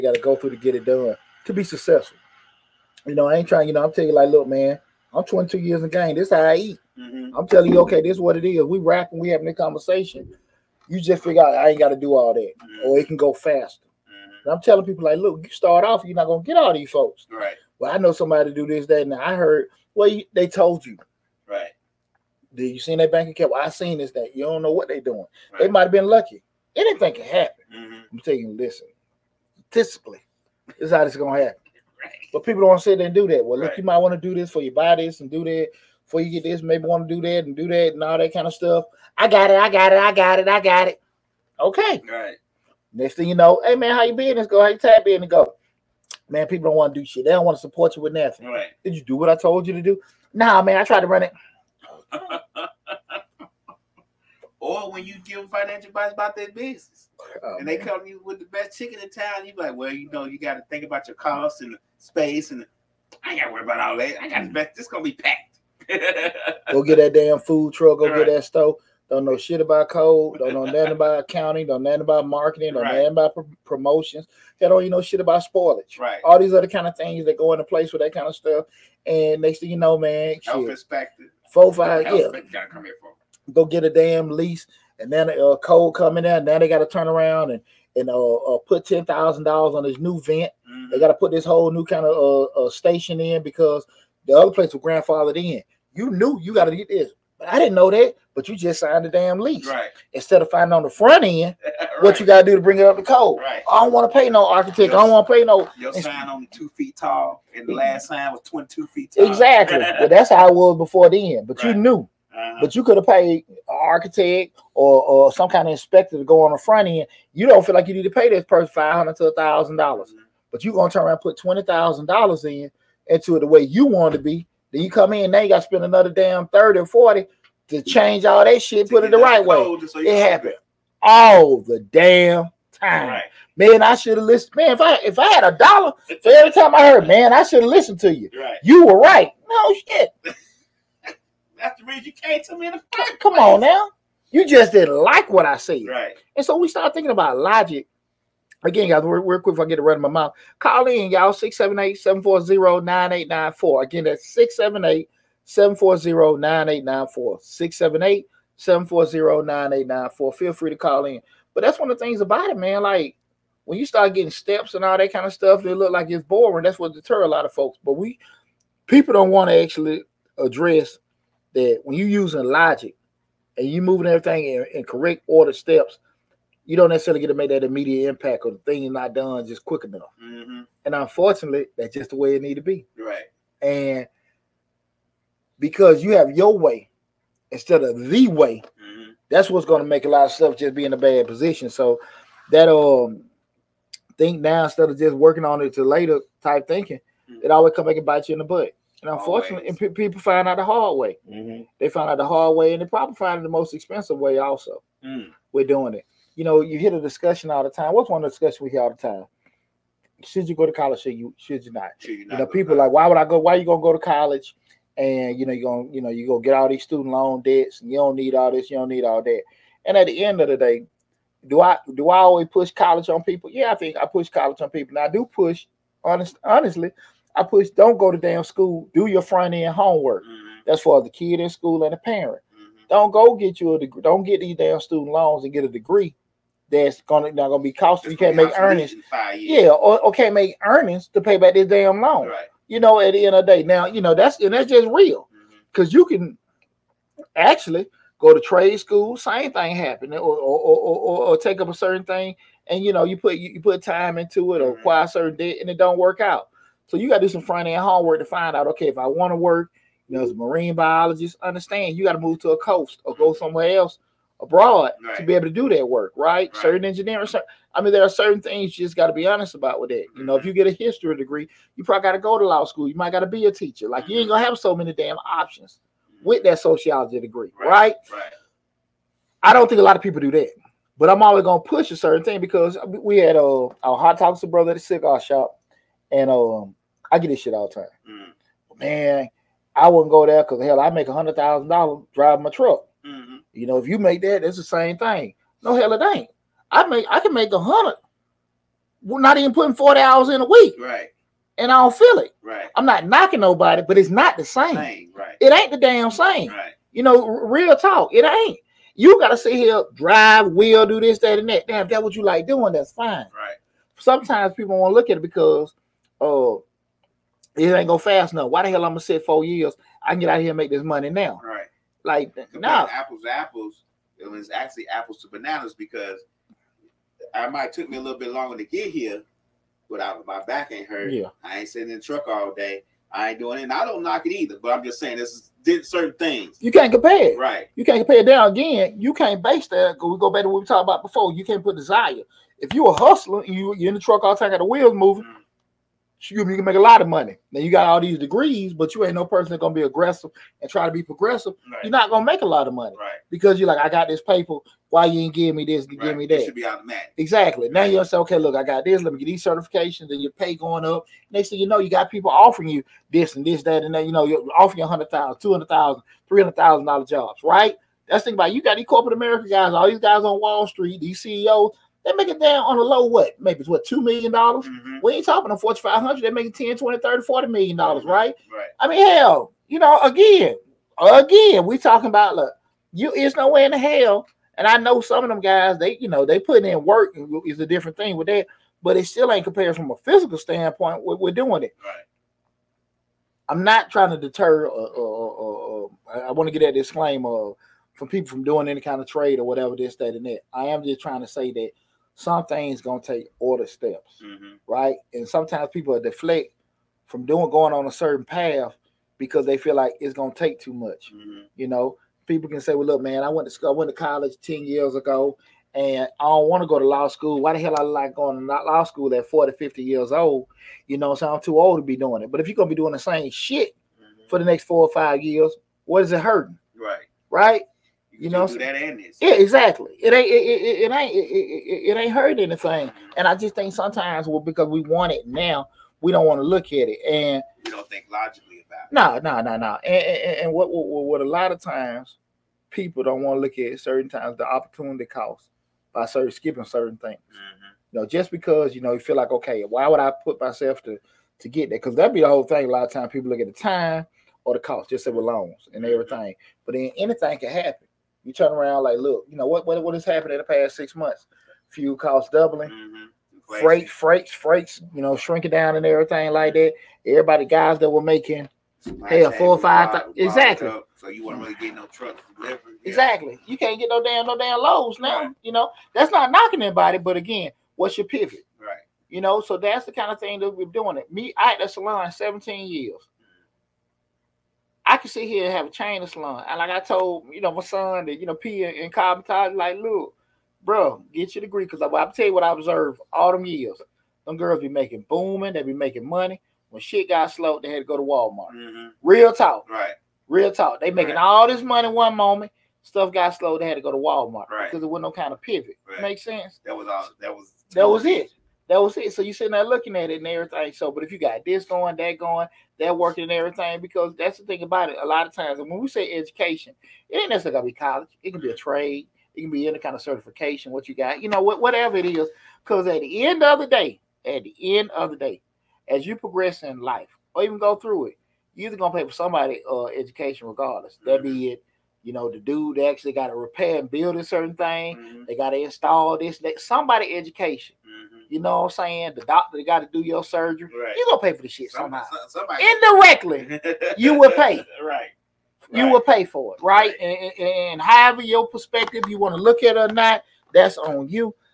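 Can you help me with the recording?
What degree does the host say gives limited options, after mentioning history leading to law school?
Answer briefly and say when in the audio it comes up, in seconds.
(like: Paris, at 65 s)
sociology, at 276 s.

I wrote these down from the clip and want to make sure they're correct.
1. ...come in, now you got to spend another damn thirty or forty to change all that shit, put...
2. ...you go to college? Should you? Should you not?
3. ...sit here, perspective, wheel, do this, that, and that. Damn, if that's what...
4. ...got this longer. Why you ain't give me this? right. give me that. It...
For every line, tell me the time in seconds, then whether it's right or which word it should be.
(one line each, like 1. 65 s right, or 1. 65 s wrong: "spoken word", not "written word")
1. 124 s right
2. 210 s right
3. 309 s wrong: "drive", not "perspective"
4. 353 s wrong: "paper", not "longer".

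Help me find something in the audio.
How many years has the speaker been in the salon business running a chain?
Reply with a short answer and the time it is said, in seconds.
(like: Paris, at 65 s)
17 years, at 482 s.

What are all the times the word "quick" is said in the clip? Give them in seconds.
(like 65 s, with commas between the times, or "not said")
149 s, 179 s.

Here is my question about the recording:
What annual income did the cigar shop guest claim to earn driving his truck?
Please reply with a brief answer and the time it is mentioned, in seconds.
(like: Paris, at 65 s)
$100,000, at 291 s.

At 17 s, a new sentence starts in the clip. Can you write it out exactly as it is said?
Well, I know somebody to do this, that, and I heard.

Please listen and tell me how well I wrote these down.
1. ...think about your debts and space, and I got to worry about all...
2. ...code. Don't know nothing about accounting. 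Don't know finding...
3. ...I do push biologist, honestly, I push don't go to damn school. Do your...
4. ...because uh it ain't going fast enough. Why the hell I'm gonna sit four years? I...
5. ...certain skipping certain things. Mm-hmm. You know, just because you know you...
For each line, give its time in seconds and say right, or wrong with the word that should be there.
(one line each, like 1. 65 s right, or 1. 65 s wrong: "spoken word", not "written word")
1. 60 s wrong: "costs", not "debts"
2. 69 s wrong: "nothing", not "finding"
3. 225 s wrong: "honest", not "biologist"
4. 315 s right
5. 446 s right.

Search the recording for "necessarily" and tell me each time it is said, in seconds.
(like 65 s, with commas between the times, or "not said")
176 s, 517 s.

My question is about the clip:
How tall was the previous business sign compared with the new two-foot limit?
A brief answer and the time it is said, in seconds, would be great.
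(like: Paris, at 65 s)
22 feet, at 108 s.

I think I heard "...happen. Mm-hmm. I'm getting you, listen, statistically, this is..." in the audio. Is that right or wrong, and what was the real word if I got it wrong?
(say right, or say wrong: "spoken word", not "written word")
wrong: "telling", not "getting".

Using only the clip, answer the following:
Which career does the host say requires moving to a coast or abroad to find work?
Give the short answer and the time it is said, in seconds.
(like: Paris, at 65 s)
marine biologist, at 260 s.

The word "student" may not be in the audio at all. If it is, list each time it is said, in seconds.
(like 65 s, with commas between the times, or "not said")
216 s, 234 s.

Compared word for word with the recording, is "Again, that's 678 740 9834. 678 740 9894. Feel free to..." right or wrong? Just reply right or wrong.
wrong.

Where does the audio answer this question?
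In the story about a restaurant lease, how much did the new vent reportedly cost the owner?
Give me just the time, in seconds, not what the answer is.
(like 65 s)
88 s.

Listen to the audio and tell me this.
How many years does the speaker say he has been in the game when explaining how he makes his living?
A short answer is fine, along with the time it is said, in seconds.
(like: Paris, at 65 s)
22 years, at 5 s.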